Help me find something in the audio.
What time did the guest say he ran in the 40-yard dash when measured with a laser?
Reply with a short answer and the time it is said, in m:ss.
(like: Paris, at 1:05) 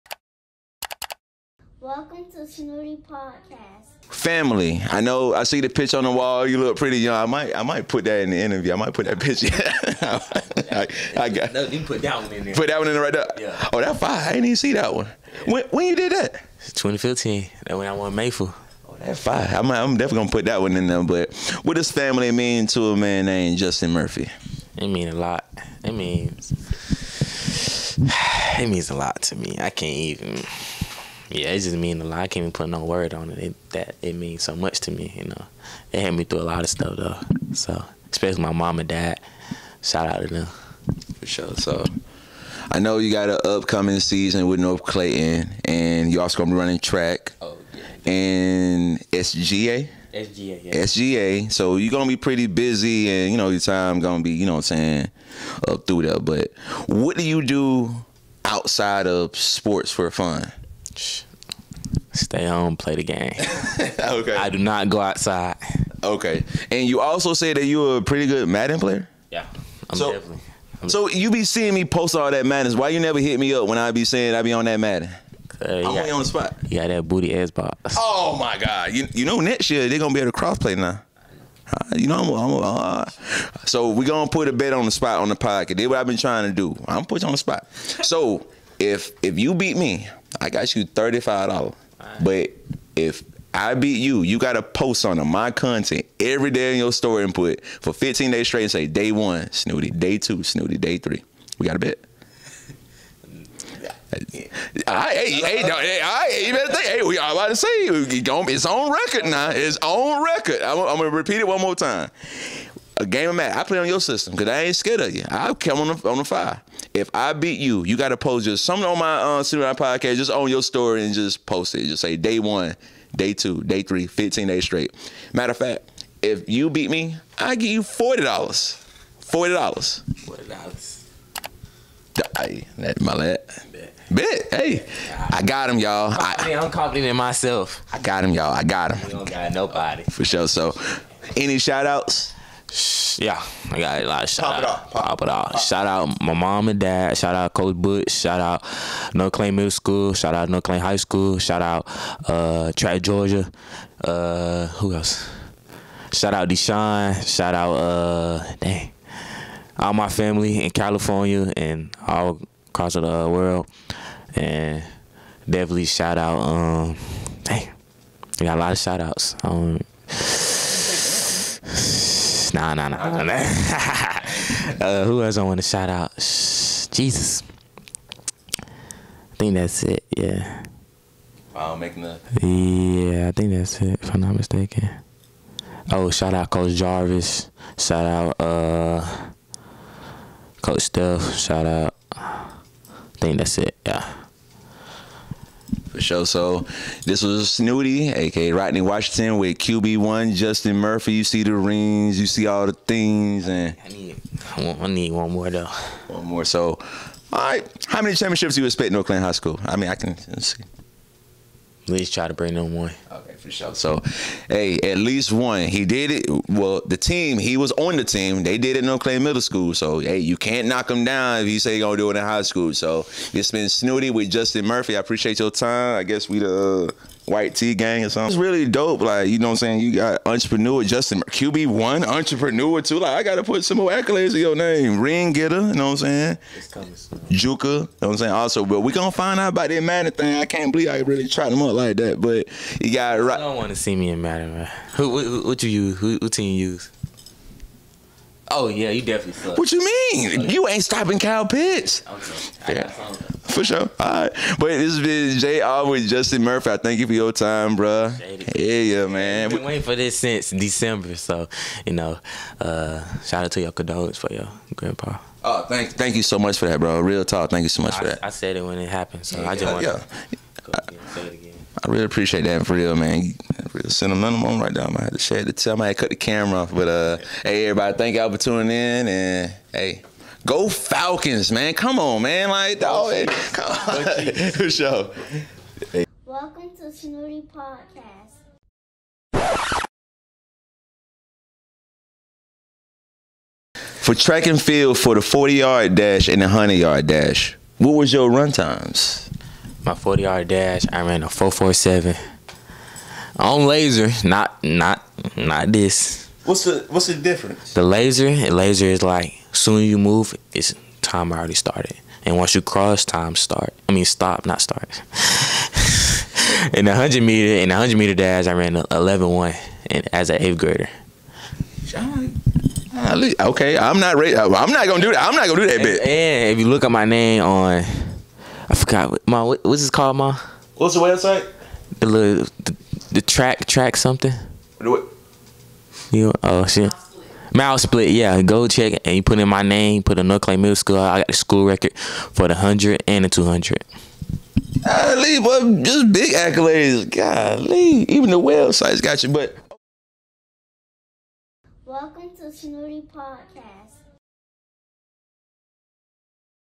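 4.47, at 5:01.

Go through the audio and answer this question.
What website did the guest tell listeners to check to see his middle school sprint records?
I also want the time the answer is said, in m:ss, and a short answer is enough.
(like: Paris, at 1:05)
MileSplit, at 5:37.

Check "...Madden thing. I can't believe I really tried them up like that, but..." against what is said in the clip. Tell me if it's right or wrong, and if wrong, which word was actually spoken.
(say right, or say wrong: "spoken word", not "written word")
right.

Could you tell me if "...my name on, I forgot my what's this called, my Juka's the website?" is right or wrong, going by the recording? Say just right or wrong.
wrong.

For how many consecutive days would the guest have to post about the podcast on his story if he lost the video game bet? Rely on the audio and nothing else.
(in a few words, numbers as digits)
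15.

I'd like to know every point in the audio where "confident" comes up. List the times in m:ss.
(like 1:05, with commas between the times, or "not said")
2:16.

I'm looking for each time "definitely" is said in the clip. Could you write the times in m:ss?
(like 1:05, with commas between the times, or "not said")
0:19, 1:10, 2:45, 4:09.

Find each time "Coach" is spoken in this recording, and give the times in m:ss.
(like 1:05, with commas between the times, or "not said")
2:27, 3:06, 3:10.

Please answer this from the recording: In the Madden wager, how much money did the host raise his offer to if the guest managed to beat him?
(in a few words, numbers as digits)
$40.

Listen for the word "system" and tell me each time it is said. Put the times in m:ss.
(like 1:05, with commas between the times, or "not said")
1:54.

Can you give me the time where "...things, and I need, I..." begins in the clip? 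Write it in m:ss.
3:22.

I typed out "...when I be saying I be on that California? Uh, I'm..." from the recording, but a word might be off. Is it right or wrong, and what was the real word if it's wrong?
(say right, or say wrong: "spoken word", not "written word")
wrong: "Madden", not "California".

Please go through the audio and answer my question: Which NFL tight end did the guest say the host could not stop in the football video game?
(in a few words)
Kyle Pitts.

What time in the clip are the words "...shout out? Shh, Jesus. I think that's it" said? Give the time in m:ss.
2:55.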